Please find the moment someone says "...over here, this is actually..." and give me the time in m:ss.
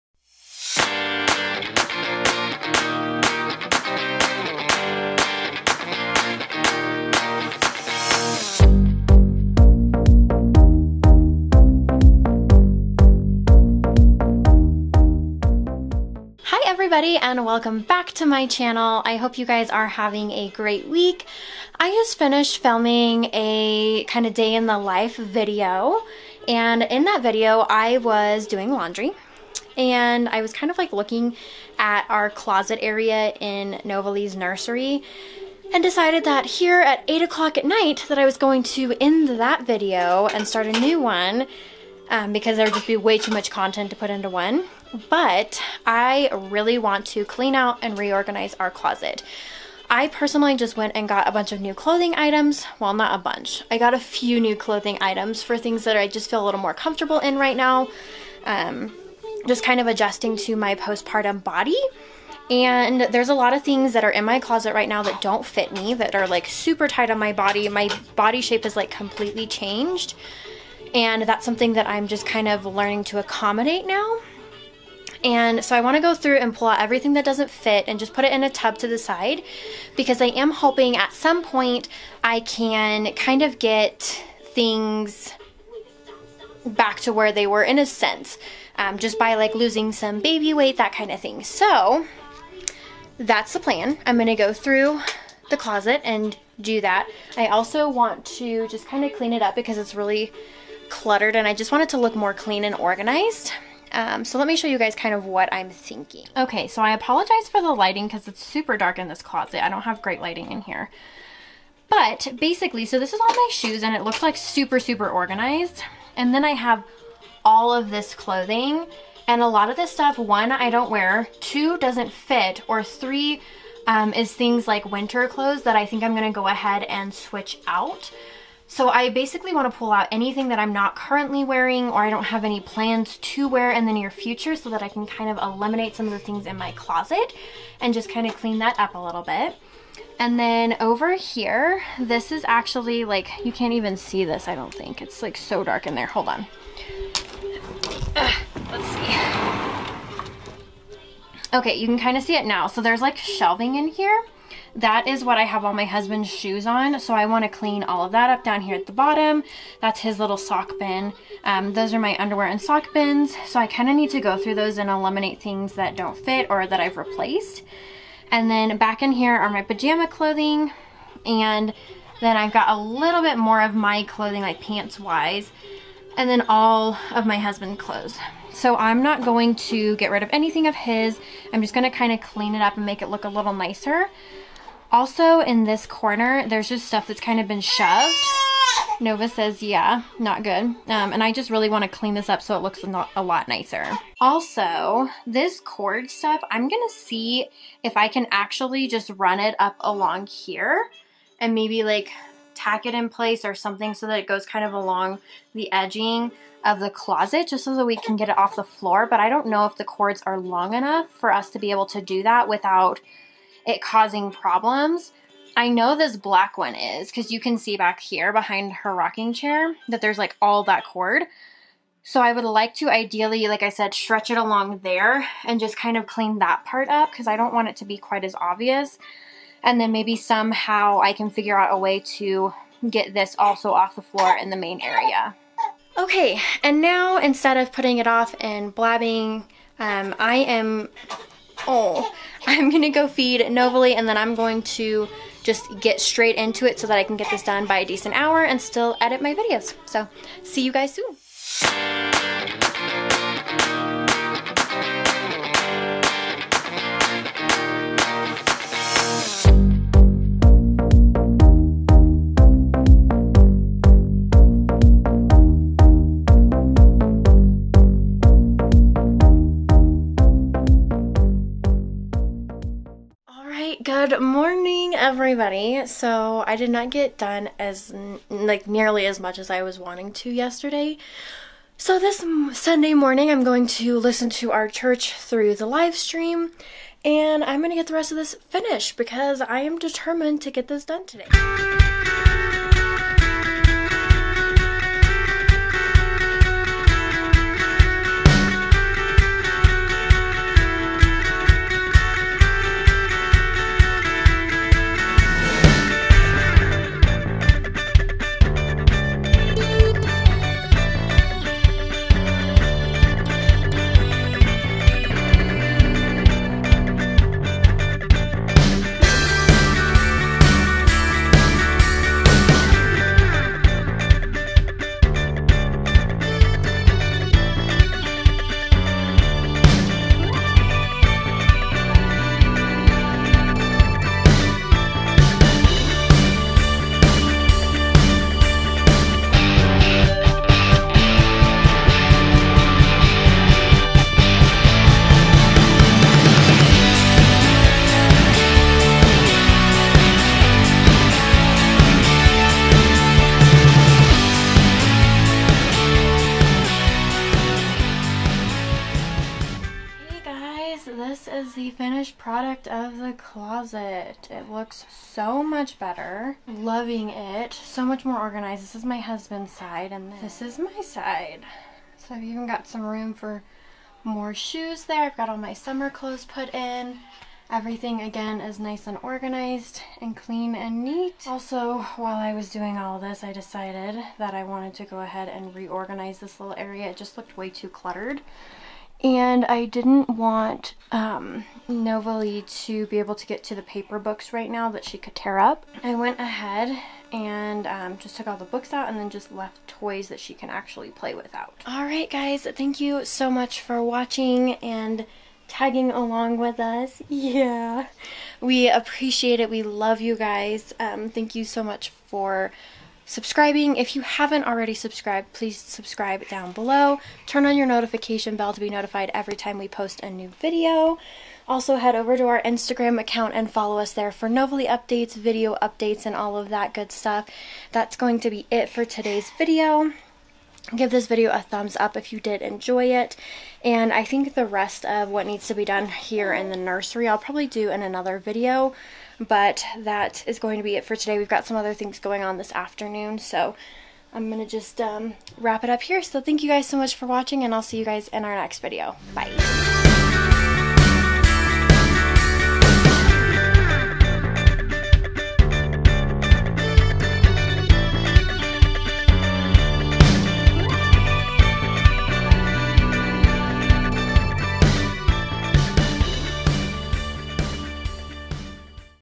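2:20.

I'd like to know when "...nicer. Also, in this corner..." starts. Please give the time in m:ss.
3:03.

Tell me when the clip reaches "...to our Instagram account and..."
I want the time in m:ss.
7:02.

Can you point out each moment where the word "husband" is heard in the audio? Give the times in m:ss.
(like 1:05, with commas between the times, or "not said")
2:35, 2:57, 6:08.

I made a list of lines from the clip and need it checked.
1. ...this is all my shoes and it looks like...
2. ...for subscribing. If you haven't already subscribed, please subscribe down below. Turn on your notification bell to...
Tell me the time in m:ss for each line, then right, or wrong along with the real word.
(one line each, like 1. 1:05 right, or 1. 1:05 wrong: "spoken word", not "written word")
1. 1:52 right
2. 6:51 right.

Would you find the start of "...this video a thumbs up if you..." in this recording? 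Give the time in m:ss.
7:10.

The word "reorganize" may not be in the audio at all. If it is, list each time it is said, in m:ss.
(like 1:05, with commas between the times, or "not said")
0:47, 6:25.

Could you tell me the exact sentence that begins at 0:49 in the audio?
I personally just went and got a bunch of new clothing items.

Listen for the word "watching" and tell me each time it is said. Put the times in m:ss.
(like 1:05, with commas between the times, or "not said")
6:43, 7:27.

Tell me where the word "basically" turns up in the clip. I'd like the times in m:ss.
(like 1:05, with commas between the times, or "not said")
1:52, 2:09.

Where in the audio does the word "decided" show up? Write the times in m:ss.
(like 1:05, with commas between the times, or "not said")
0:35, 6:23.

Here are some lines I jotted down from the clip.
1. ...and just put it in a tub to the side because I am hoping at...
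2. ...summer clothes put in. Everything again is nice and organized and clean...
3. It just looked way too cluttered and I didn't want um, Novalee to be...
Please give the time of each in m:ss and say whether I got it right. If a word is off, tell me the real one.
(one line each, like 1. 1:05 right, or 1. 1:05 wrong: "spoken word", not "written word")
1. 1:17 right
2. 6:15 right
3. 6:26 right.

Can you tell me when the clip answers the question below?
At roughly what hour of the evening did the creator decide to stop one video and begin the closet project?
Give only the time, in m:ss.
0:37.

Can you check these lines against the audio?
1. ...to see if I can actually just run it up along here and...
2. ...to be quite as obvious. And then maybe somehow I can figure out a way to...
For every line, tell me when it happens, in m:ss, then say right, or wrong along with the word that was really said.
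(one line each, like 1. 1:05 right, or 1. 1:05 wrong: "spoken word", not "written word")
1. 3:16 right
2. 3:47 right.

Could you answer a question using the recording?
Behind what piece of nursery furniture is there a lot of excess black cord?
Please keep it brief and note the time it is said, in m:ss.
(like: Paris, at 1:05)
rocking chair, at 3:38.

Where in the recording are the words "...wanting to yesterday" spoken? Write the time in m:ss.
4:39.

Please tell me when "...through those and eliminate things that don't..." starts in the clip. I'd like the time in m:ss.
2:44.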